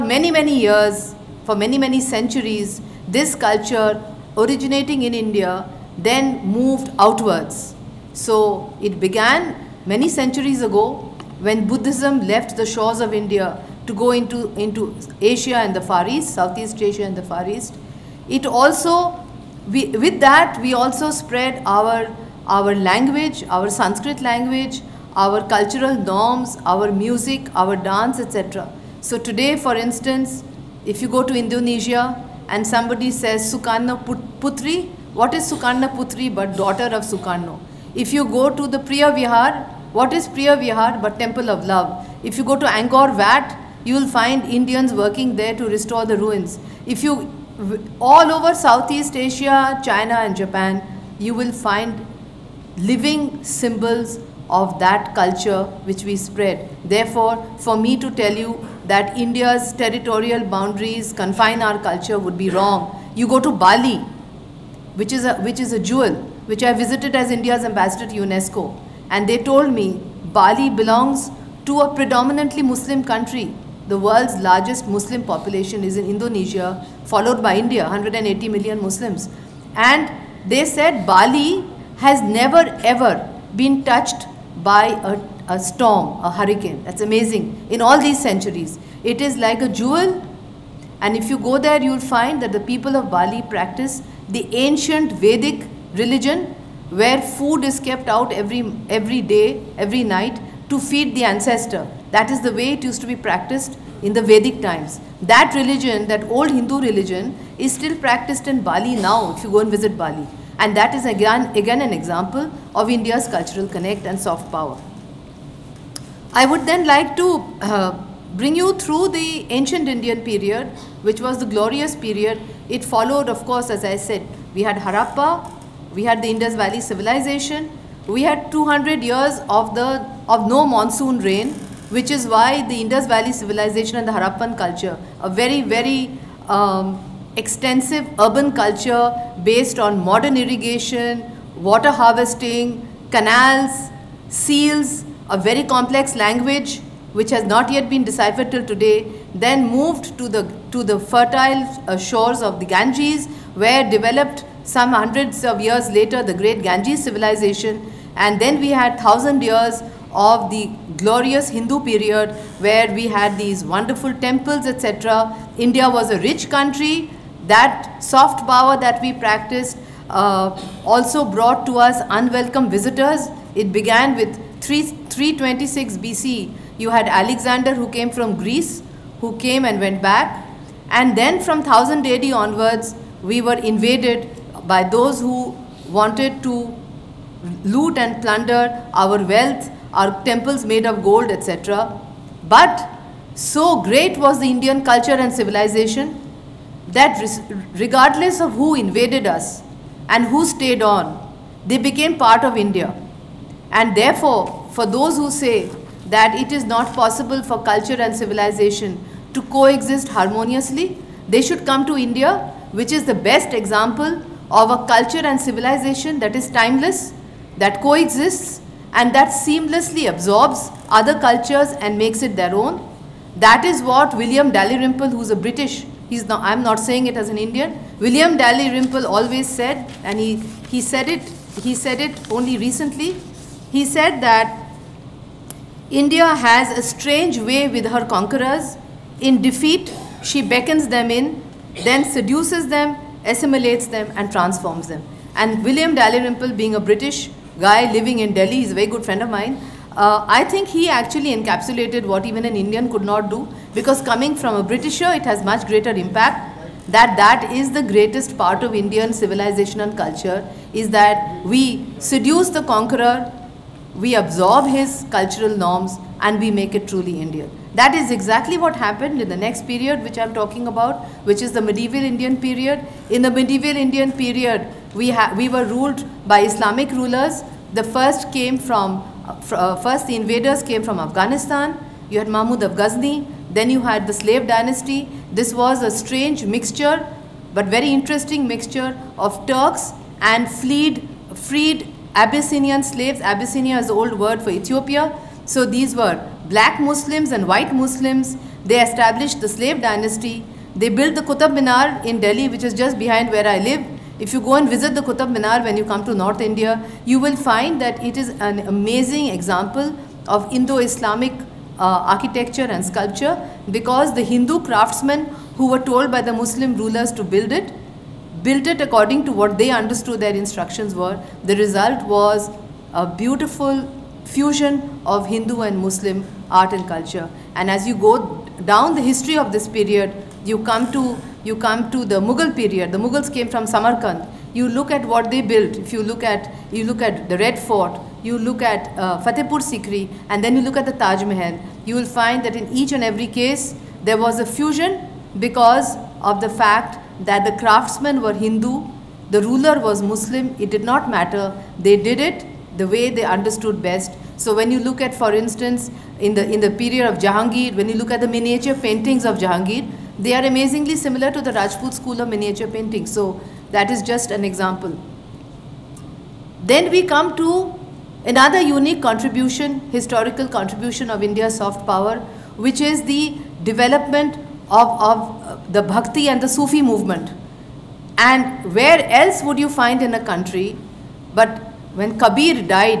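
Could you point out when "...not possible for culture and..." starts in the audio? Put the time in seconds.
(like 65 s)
206 s.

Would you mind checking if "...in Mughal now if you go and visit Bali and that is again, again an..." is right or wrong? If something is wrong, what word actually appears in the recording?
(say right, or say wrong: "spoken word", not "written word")
wrong: "Bali", not "Mughal".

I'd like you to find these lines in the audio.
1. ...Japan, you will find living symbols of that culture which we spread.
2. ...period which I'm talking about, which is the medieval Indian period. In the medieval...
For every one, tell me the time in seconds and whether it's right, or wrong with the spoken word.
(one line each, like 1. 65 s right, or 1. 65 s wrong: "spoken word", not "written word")
1. 50 s right
2. 269 s right.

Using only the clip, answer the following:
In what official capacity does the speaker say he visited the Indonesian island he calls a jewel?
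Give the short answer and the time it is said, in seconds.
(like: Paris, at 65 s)
India's ambassador to UNESCO, at 67 s.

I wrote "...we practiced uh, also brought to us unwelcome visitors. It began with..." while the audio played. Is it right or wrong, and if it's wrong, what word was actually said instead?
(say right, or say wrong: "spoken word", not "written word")
right.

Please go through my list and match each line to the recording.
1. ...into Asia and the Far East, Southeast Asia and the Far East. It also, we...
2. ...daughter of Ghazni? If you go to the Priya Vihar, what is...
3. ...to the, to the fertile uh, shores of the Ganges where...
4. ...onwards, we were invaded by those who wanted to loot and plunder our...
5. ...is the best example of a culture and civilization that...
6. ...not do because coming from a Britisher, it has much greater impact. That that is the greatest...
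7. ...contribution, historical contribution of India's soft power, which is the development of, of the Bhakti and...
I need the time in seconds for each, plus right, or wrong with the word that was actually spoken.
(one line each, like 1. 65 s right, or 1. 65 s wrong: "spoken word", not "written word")
1. 14 s right
2. 36 s wrong: "Sukarno", not "Ghazni"
3. 150 s right
4. 182 s right
5. 212 s right
6. 253 s right
7. 369 s right.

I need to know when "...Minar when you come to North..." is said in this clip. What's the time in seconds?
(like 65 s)
305 s.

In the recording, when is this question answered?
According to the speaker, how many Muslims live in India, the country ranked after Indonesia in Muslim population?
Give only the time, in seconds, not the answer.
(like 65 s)
77 s.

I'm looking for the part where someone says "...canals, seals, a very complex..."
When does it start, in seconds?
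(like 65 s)
143 s.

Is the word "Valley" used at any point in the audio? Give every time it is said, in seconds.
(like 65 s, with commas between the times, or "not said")
126 s, 133 s.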